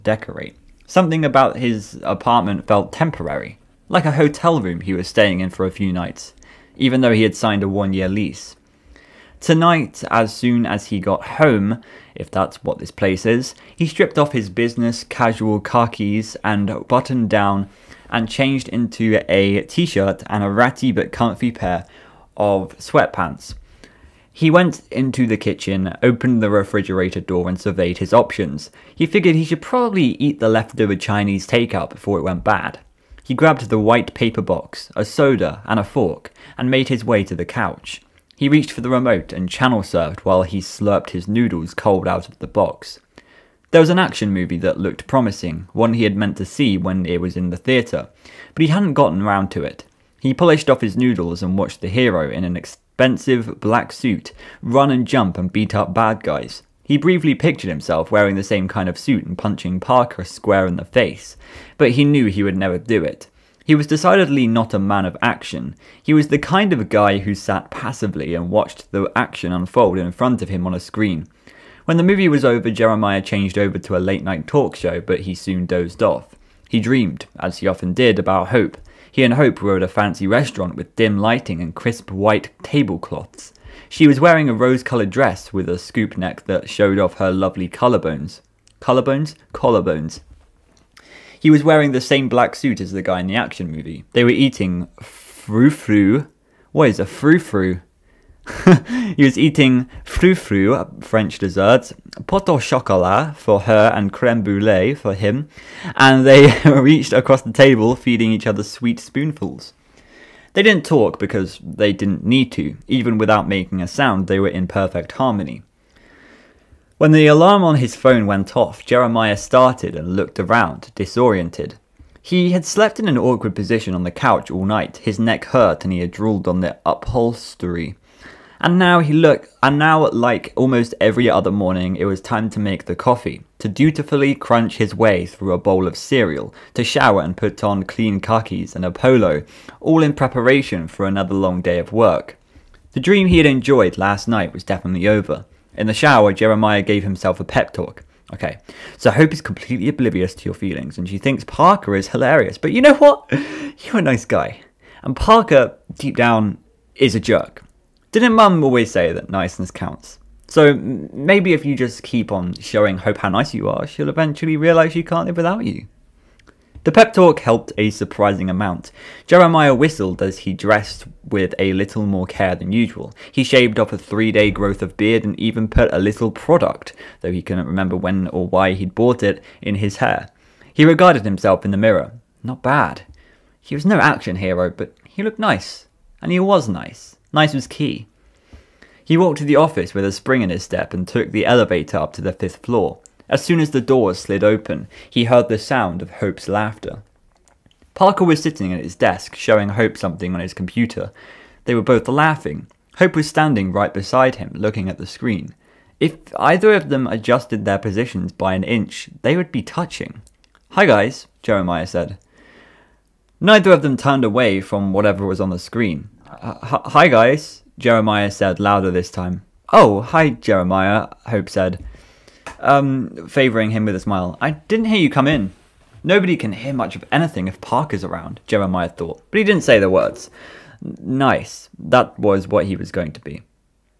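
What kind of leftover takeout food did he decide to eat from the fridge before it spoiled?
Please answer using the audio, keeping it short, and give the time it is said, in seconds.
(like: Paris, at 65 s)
Chinese takeout, at 30 s.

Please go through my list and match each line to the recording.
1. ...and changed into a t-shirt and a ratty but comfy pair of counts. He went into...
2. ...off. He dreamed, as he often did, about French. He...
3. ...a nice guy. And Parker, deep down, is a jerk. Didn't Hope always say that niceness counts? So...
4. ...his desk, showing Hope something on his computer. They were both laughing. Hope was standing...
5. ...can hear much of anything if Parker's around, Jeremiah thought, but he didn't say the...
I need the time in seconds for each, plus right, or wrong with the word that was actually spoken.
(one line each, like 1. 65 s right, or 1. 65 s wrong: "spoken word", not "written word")
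1. 18 s wrong: "sweatpants", not "counts"
2. 76 s wrong: "Hope", not "French"
3. 153 s wrong: "Mum", not "Hope"
4. 198 s right
5. 226 s right.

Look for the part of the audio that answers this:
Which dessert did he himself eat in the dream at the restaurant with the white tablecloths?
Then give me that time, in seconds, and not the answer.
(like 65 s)
104 s.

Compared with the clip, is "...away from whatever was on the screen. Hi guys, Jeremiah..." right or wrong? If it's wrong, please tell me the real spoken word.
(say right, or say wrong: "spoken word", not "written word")
right.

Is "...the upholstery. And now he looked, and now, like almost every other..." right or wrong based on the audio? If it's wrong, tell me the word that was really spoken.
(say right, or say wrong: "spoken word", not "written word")
right.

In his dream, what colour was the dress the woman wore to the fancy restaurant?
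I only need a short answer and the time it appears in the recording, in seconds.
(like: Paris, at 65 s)
rose, at 84 s.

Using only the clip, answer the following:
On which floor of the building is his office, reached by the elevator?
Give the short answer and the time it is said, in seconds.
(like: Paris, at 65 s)
5th, at 192 s.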